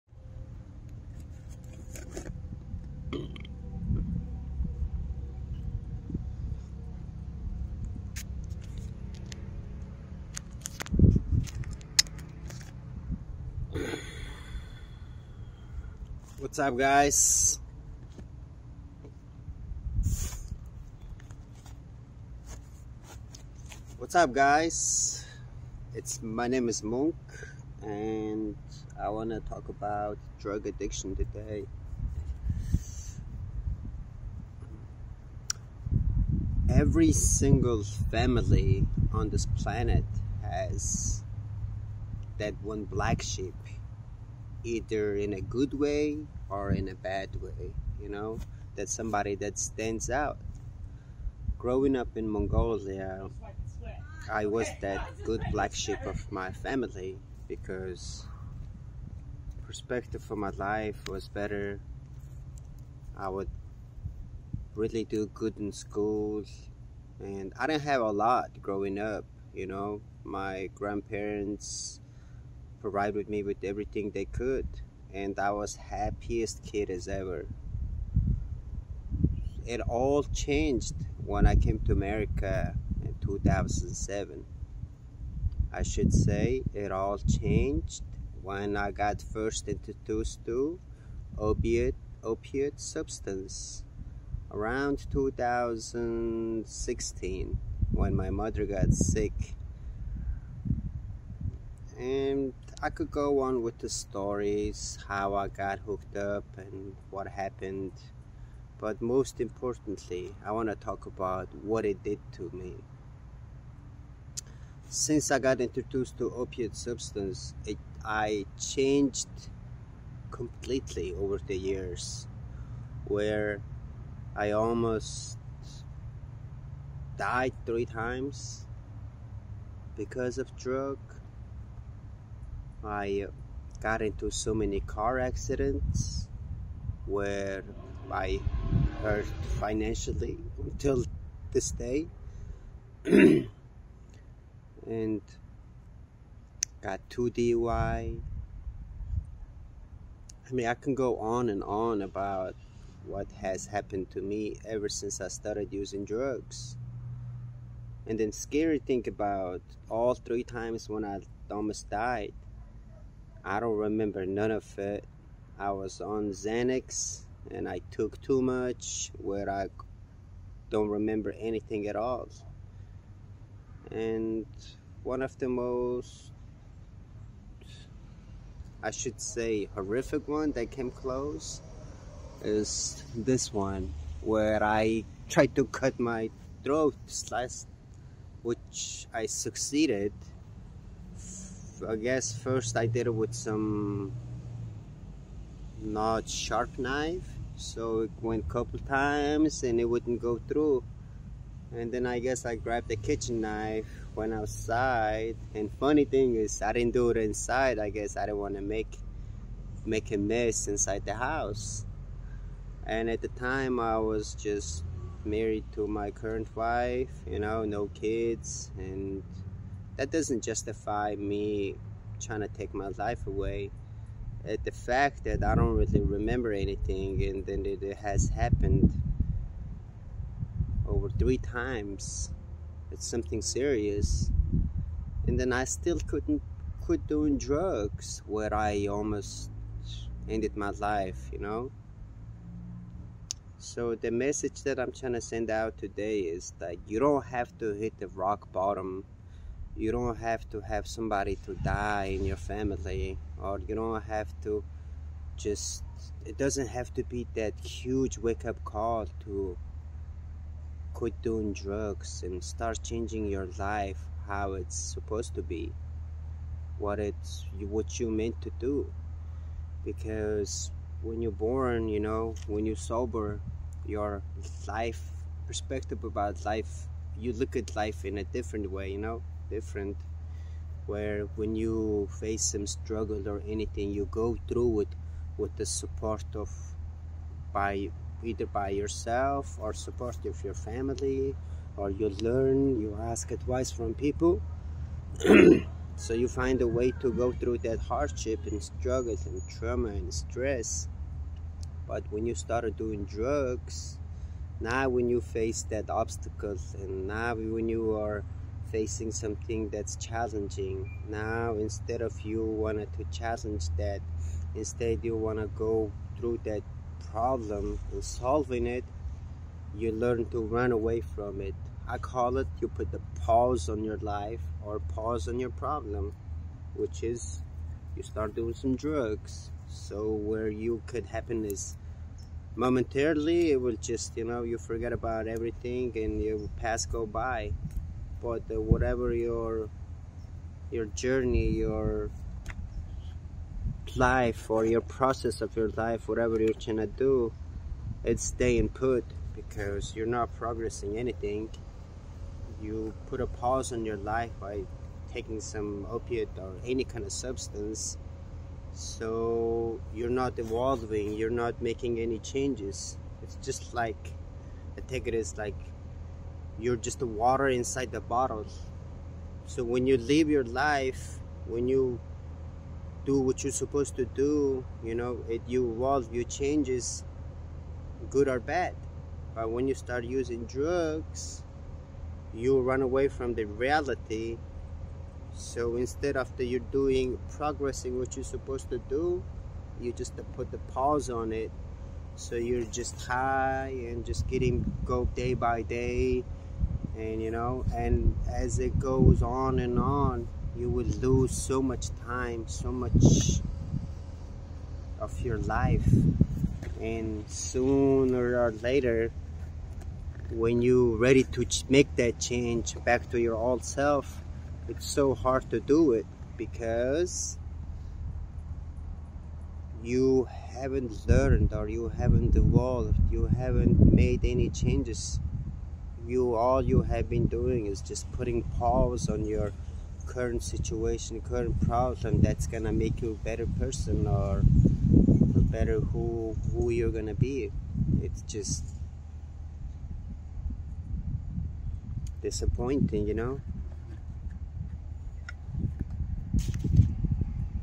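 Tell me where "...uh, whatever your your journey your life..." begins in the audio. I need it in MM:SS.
05:38.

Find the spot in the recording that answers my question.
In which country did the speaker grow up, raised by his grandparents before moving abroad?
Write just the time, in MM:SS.
00:52.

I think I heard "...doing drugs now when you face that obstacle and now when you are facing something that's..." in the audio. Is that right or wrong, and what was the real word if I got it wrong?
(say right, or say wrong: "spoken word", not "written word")
right.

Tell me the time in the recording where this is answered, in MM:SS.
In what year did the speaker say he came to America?
01:23.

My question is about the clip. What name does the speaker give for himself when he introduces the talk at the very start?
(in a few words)
Monk.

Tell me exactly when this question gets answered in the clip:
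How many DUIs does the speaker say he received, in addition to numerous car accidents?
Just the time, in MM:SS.
02:27.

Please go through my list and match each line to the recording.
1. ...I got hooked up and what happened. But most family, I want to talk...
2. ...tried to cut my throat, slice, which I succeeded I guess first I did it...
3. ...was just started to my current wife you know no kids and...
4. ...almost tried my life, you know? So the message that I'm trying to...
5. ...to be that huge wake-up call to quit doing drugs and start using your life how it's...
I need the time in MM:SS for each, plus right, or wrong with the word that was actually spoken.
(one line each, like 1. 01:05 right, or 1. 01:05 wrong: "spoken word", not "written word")
1. 01:45 wrong: "importantly", not "family"
2. 03:05 right
3. 03:33 wrong: "married", not "started"
4. 03:58 wrong: "ended", not "tried"
5. 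04:16 wrong: "changing", not "using".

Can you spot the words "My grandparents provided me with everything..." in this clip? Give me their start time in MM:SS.
01:10.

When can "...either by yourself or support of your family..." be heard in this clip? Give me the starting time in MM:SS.
04:48.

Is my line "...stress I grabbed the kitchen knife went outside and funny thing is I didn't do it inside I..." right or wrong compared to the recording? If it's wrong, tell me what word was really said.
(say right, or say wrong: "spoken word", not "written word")
wrong: "guess", not "stress".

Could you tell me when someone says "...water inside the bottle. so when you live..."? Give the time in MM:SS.
06:07.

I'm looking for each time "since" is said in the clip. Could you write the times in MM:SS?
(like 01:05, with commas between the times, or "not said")
01:54, 02:34.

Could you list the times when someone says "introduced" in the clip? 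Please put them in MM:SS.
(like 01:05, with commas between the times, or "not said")
01:29, 01:55.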